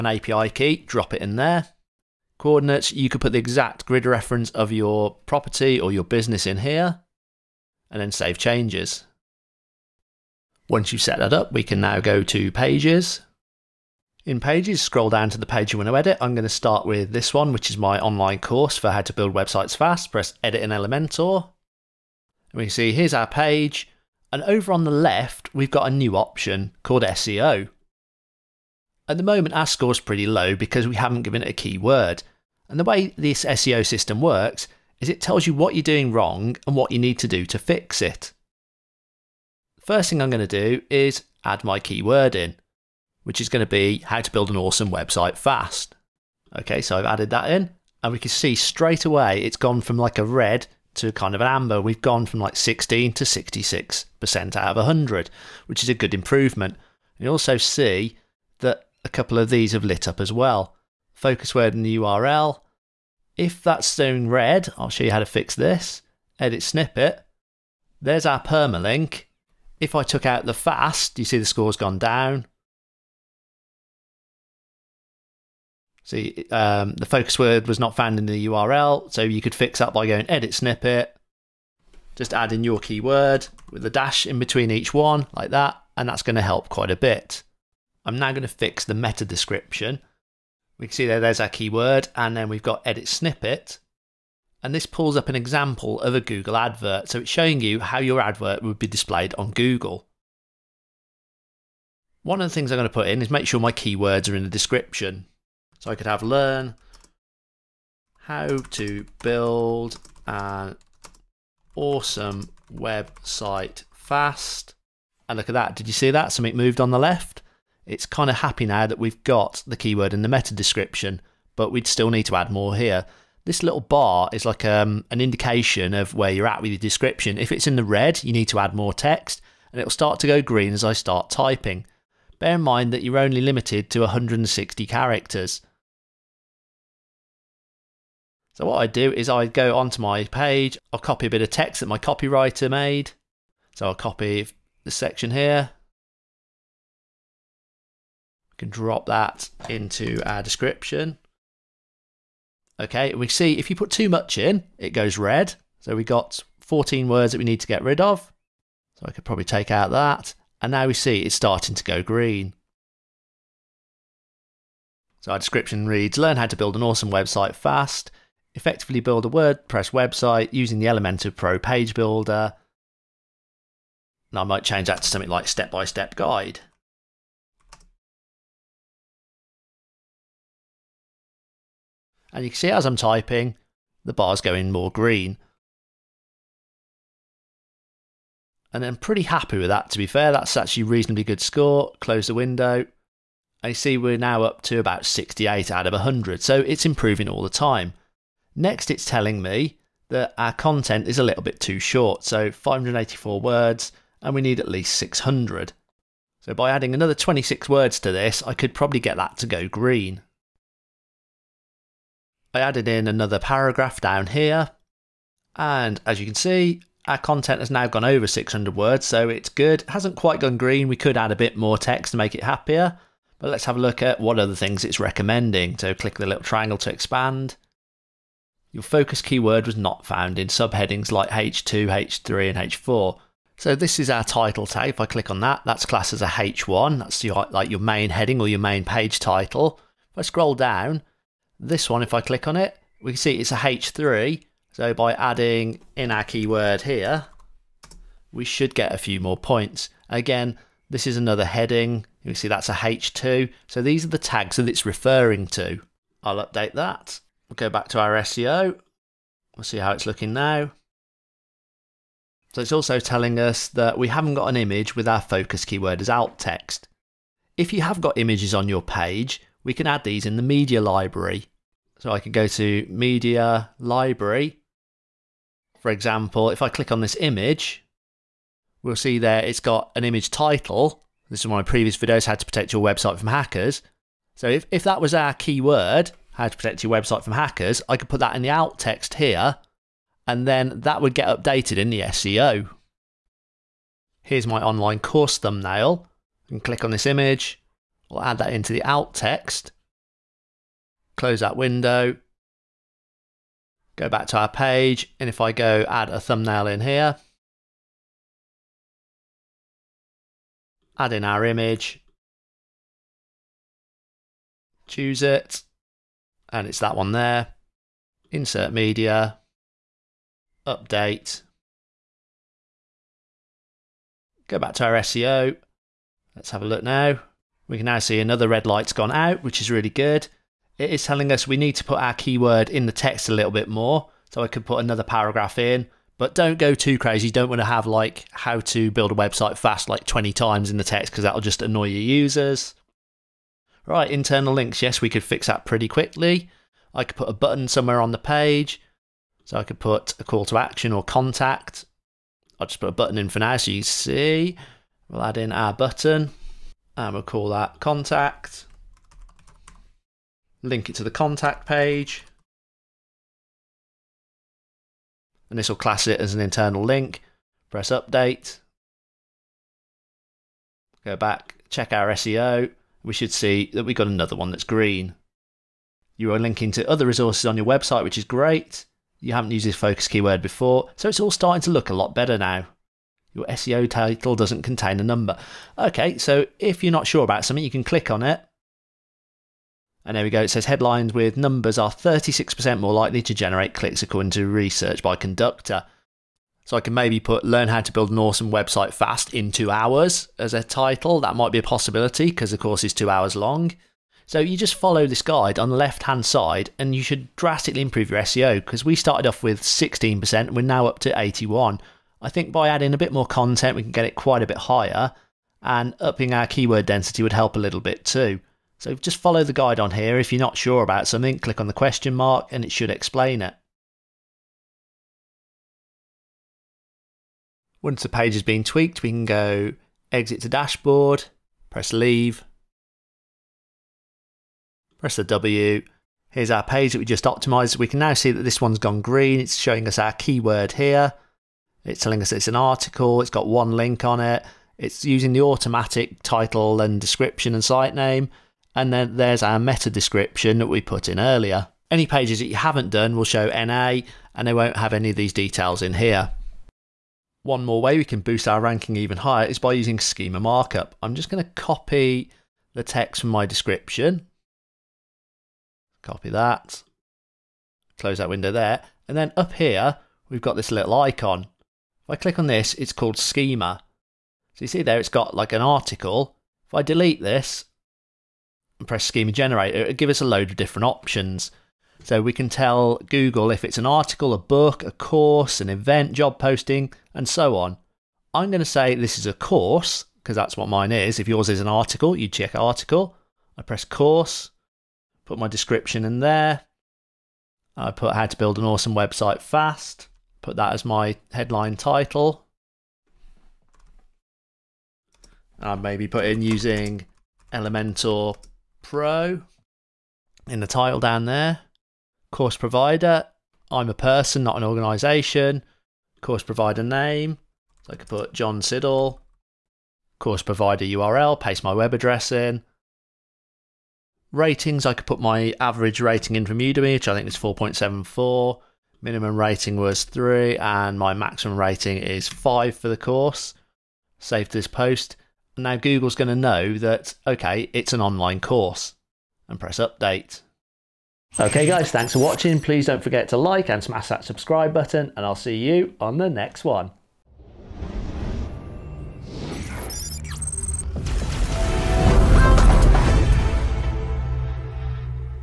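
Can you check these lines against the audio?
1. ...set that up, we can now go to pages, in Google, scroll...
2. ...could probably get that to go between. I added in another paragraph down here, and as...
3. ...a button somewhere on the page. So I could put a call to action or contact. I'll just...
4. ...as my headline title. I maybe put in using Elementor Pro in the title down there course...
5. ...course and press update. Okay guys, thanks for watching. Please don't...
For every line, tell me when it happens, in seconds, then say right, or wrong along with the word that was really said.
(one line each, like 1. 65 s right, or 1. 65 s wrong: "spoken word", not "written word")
1. 11 s wrong: "Pages", not "Google"
2. 208 s wrong: "green", not "between"
3. 347 s right
4. 500 s right
5. 538 s right.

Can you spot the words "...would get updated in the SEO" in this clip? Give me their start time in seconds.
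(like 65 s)
291 s.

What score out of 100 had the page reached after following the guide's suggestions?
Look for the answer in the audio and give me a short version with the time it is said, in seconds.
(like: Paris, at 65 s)
81, at 411 s.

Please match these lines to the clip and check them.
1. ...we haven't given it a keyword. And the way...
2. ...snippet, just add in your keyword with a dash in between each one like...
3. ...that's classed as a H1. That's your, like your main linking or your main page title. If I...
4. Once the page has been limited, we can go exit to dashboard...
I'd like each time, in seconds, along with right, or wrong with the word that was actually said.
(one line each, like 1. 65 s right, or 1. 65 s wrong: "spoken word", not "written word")
1. 30 s right
2. 80 s right
3. 235 s wrong: "heading", not "linking"
4. 427 s wrong: "tweaked", not "limited".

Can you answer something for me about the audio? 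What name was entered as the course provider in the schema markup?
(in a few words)
John Siddle.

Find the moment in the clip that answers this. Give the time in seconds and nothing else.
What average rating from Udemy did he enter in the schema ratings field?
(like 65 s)
527 s.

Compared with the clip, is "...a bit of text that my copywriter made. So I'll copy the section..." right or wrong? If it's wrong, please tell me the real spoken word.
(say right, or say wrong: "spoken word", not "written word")
right.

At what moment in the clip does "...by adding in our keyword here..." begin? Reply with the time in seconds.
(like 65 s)
244 s.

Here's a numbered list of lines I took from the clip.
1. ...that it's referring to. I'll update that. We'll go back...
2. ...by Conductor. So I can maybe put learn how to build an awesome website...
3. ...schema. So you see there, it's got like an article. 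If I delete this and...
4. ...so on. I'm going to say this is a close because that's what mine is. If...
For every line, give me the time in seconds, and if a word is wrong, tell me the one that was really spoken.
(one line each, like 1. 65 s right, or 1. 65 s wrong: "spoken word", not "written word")
1. 254 s right
2. 395 s right
3. 473 s right
4. 487 s wrong: "course", not "close".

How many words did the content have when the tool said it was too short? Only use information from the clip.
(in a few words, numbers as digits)
584.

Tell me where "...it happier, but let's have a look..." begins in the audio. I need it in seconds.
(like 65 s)
222 s.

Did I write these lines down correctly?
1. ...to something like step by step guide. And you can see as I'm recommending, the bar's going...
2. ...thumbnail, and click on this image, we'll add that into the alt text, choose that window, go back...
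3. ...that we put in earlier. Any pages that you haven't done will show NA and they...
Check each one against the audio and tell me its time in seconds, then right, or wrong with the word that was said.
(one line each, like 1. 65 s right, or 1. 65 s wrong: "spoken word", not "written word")
1. 175 s wrong: "typing", not "recommending"
2. 295 s wrong: "close", not "choose"
3. 450 s right.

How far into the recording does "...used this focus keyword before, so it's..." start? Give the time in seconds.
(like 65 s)
379 s.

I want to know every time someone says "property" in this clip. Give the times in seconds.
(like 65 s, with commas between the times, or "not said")
5 s.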